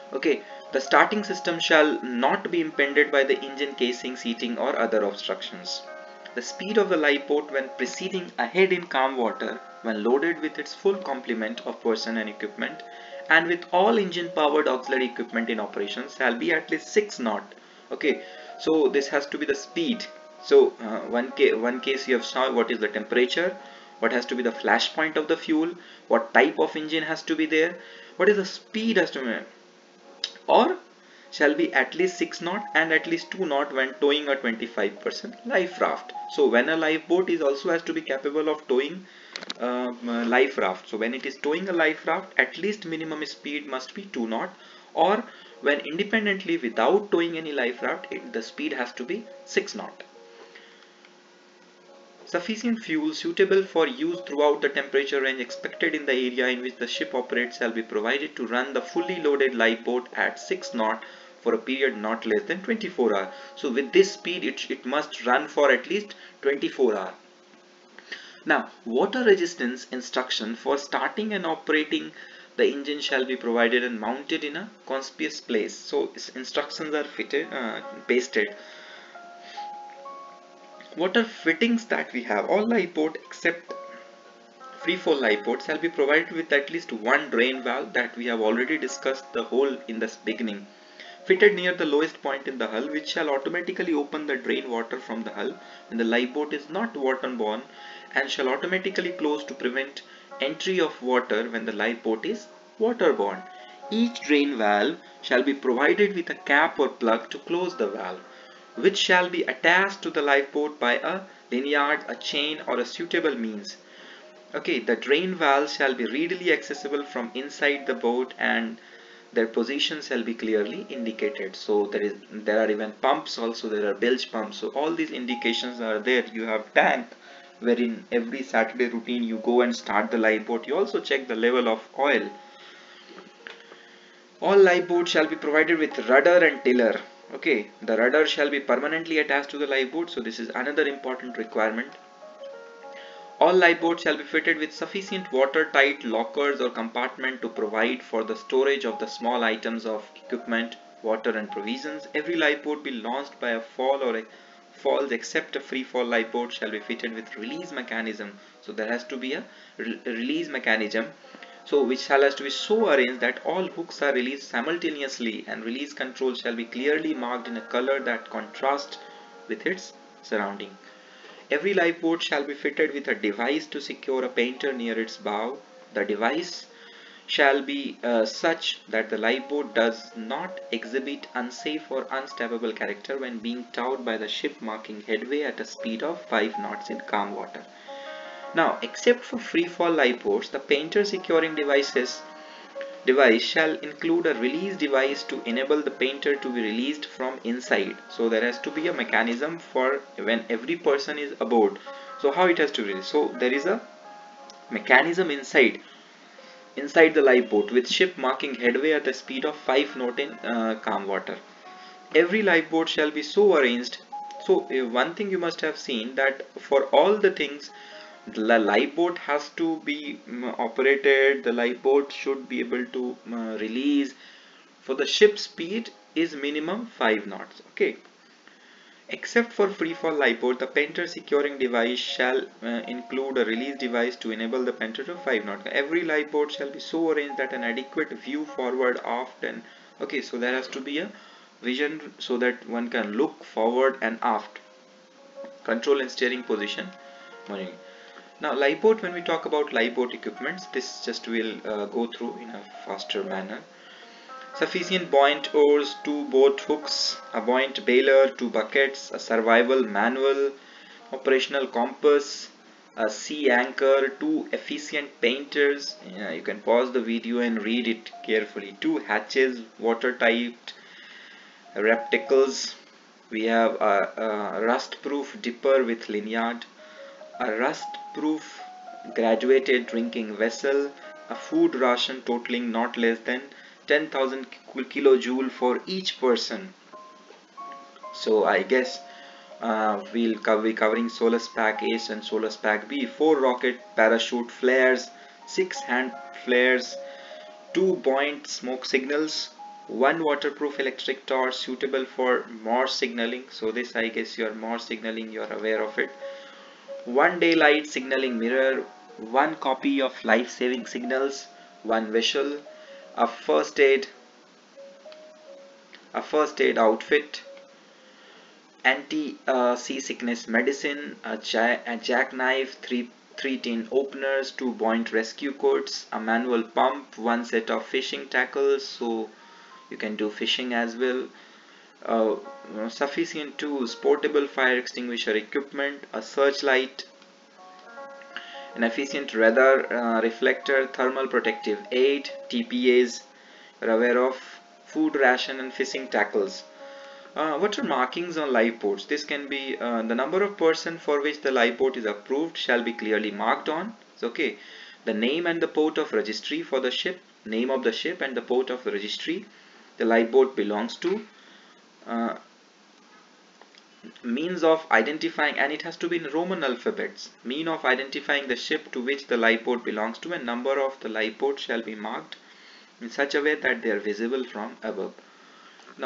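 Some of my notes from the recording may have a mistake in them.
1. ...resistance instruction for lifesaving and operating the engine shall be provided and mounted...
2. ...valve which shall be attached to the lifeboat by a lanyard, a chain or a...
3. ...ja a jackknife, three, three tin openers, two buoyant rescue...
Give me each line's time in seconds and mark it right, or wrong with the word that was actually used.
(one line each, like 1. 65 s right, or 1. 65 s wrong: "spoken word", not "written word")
1. 69 s wrong: "starting", not "lifesaving"
2. 107 s right
3. 321 s right.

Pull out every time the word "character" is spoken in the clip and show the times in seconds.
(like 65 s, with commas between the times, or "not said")
182 s.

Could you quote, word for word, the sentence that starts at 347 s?
Uh, what are markings on lifeboats?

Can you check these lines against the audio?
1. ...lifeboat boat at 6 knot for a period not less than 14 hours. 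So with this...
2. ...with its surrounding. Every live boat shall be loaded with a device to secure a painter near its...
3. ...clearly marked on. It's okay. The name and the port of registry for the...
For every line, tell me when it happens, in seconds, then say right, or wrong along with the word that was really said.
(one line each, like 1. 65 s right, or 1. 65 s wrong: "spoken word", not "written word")
1. 59 s wrong: "24", not "14"
2. 169 s wrong: "fitted", not "loaded"
3. 352 s right.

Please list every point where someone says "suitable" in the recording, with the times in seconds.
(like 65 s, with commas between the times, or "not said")
53 s, 112 s, 301 s.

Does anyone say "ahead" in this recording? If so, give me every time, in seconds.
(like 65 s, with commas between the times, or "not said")
8 s.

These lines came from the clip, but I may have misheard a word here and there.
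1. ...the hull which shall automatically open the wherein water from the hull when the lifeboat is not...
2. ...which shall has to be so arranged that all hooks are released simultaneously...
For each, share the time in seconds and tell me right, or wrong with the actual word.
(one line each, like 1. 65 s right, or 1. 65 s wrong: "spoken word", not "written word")
1. 92 s wrong: "drain", not "wherein"
2. 161 s right.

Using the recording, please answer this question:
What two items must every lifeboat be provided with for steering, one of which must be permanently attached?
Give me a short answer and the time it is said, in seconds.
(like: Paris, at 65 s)
rudder and tiller, at 136 s.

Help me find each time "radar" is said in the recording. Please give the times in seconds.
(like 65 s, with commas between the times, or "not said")
339 s.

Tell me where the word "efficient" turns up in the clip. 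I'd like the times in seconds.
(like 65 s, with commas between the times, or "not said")
264 s, 338 s.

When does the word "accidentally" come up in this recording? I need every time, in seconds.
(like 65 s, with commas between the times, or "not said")
not said.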